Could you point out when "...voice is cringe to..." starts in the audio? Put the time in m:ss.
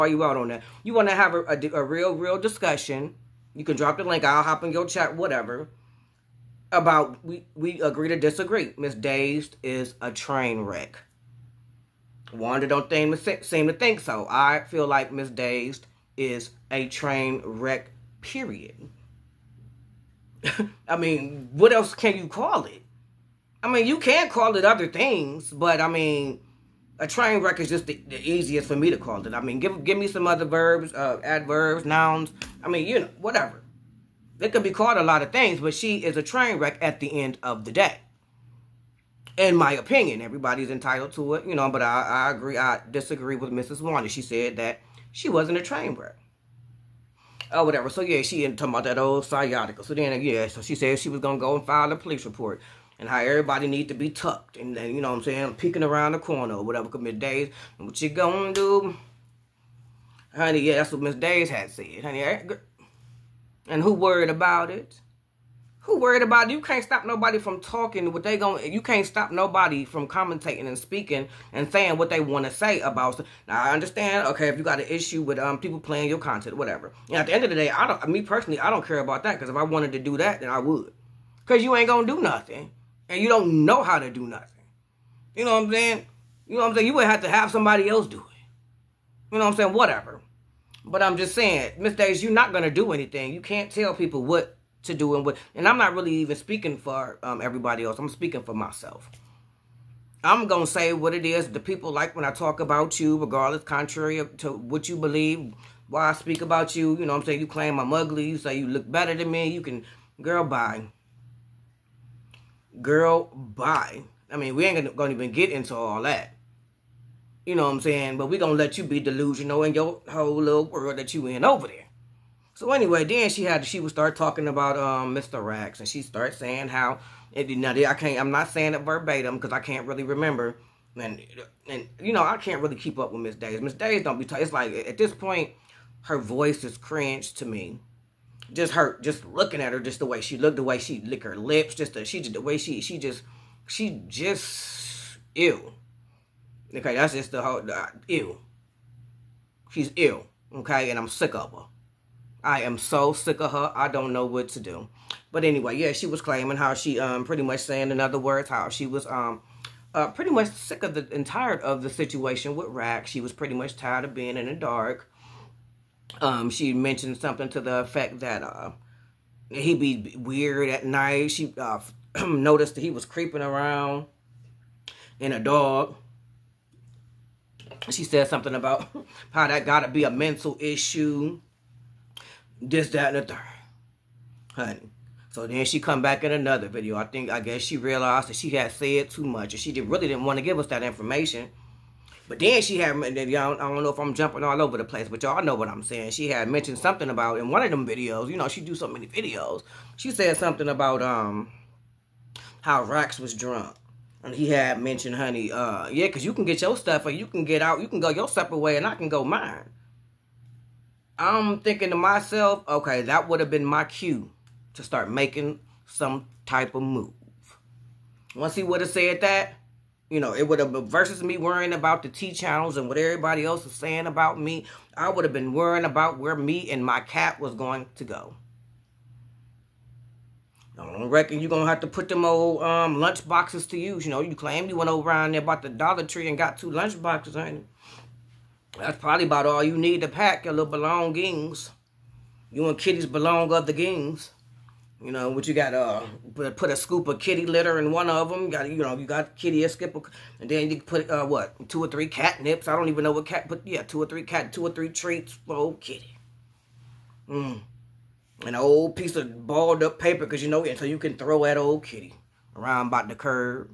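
2:16.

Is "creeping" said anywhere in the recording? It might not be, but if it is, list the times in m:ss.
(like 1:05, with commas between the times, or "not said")
2:53.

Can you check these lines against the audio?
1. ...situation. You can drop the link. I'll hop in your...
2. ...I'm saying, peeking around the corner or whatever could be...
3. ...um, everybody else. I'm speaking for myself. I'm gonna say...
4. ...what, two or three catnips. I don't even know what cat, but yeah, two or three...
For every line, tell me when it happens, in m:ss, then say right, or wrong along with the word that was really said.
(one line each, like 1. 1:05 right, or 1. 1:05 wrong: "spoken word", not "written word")
1. 0:02 wrong: "discussion", not "situation"
2. 0:55 right
3. 1:37 right
4. 4:11 right.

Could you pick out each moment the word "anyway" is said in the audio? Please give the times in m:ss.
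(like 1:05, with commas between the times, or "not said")
2:02, 2:35.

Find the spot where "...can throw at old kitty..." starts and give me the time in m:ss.
4:20.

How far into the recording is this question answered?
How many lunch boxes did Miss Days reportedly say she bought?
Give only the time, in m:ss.
3:56.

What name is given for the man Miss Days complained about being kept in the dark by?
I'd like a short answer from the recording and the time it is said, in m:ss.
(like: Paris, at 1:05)
Mr. Rax, at 2:05.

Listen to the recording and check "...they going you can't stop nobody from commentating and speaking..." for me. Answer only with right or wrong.
right.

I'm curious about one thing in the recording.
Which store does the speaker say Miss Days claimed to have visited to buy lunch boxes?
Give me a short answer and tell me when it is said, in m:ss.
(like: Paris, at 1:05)
Dollar Tree, at 3:55.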